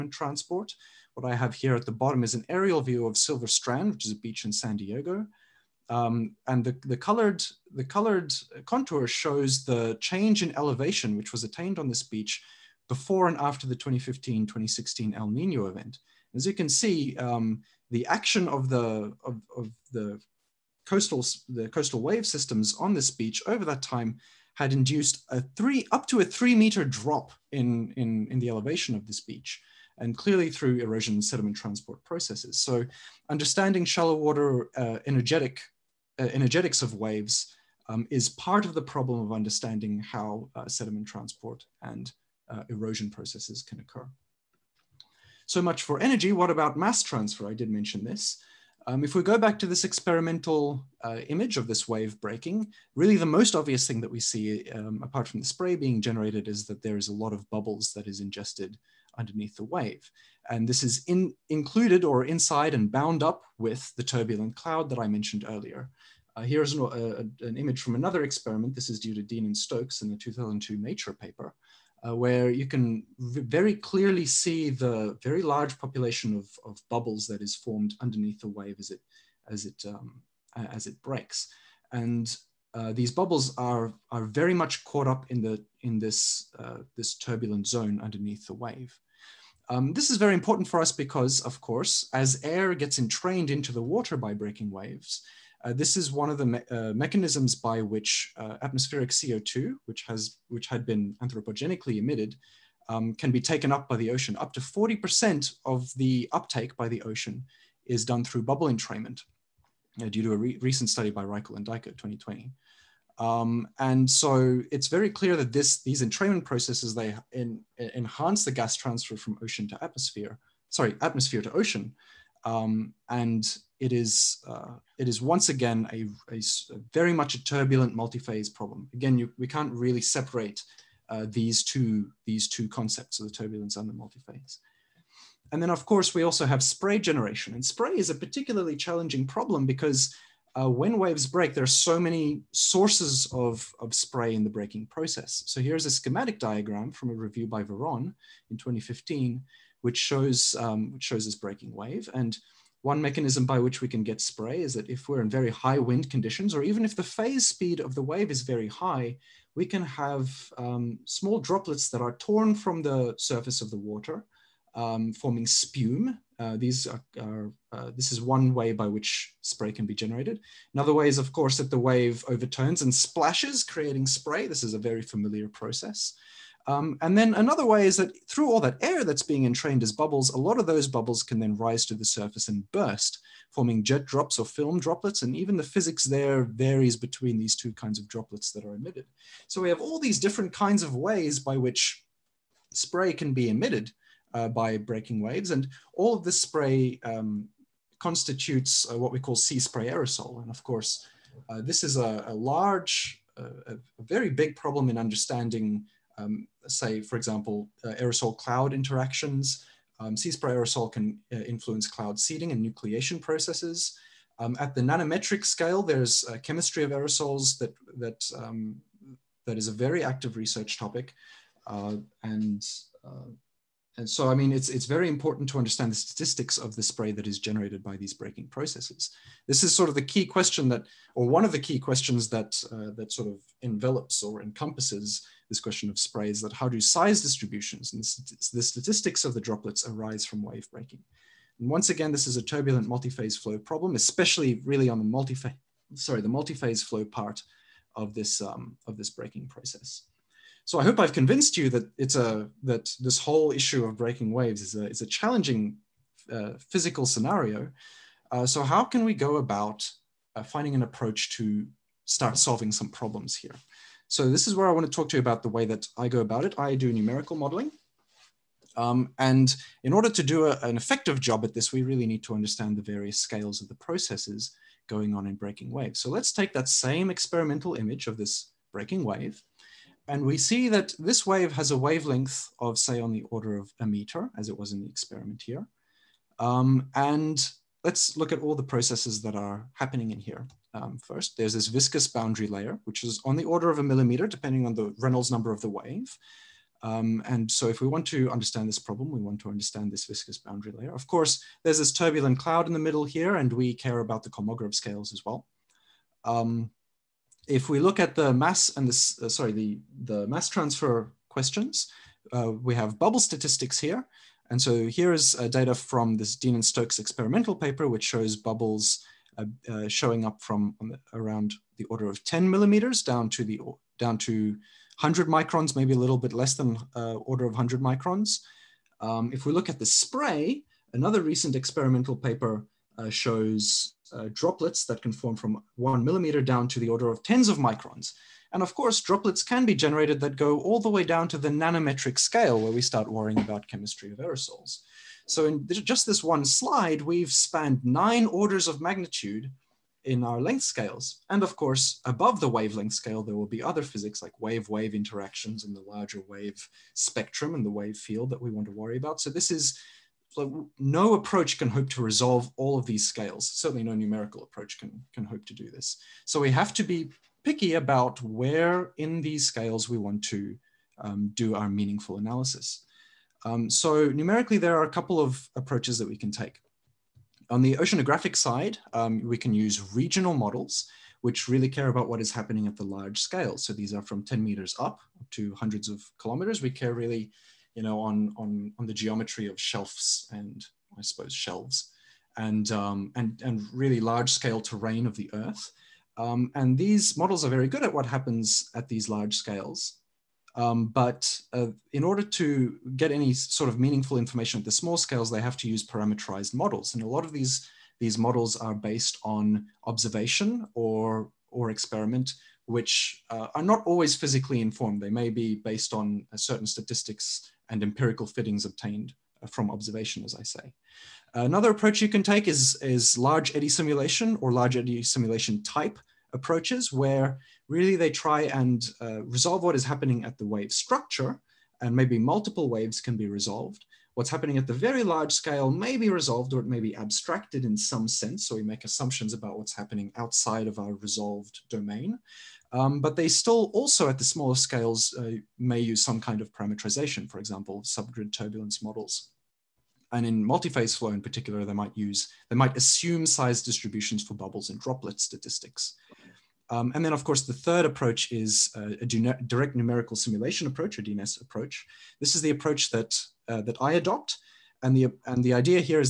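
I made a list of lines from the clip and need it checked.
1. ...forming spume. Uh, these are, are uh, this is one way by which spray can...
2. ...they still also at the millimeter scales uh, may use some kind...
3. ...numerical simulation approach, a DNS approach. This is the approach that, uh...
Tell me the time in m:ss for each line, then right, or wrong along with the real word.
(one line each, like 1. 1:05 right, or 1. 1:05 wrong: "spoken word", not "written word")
1. 2:45 right
2. 7:23 wrong: "smaller", not "millimeter"
3. 7:39 right.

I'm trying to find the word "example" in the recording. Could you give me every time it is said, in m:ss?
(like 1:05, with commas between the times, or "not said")
3:27, 7:27.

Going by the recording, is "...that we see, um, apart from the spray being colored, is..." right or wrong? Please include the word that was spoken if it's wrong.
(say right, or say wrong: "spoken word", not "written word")
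wrong: "generated", not "colored".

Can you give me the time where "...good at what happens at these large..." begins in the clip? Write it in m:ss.
6:37.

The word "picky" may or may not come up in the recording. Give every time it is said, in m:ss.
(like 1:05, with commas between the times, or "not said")
6:07.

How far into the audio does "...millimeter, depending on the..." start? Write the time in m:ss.
4:53.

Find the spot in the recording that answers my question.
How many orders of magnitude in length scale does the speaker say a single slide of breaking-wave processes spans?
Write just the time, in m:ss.
5:47.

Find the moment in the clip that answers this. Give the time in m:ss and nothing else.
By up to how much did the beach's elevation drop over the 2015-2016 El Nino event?
0:25.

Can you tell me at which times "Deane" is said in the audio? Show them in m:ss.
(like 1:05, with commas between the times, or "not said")
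1:09, 5:16.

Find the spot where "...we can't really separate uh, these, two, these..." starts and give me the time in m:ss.
2:09.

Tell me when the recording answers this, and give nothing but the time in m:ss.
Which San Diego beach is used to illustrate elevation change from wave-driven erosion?
0:03.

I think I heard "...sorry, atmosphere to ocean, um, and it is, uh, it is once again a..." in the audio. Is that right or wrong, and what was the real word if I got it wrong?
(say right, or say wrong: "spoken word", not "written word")
right.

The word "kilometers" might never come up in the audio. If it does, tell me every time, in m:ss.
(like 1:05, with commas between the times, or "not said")
6:26.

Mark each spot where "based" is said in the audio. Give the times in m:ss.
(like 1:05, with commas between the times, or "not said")
6:48, 6:55.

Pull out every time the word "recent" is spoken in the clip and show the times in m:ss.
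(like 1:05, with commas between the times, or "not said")
1:50, 5:31.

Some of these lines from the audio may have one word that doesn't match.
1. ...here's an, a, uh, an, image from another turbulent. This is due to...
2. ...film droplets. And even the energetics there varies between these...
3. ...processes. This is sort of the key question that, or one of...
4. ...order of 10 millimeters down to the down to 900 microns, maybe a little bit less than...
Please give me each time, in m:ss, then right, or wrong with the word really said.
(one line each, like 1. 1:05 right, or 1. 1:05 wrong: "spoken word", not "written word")
1. 1:06 wrong: "experiment", not "turbulent"
2. 3:04 wrong: "physics", not "energetics"
3. 3:48 right
4. 5:21 wrong: "100", not "900".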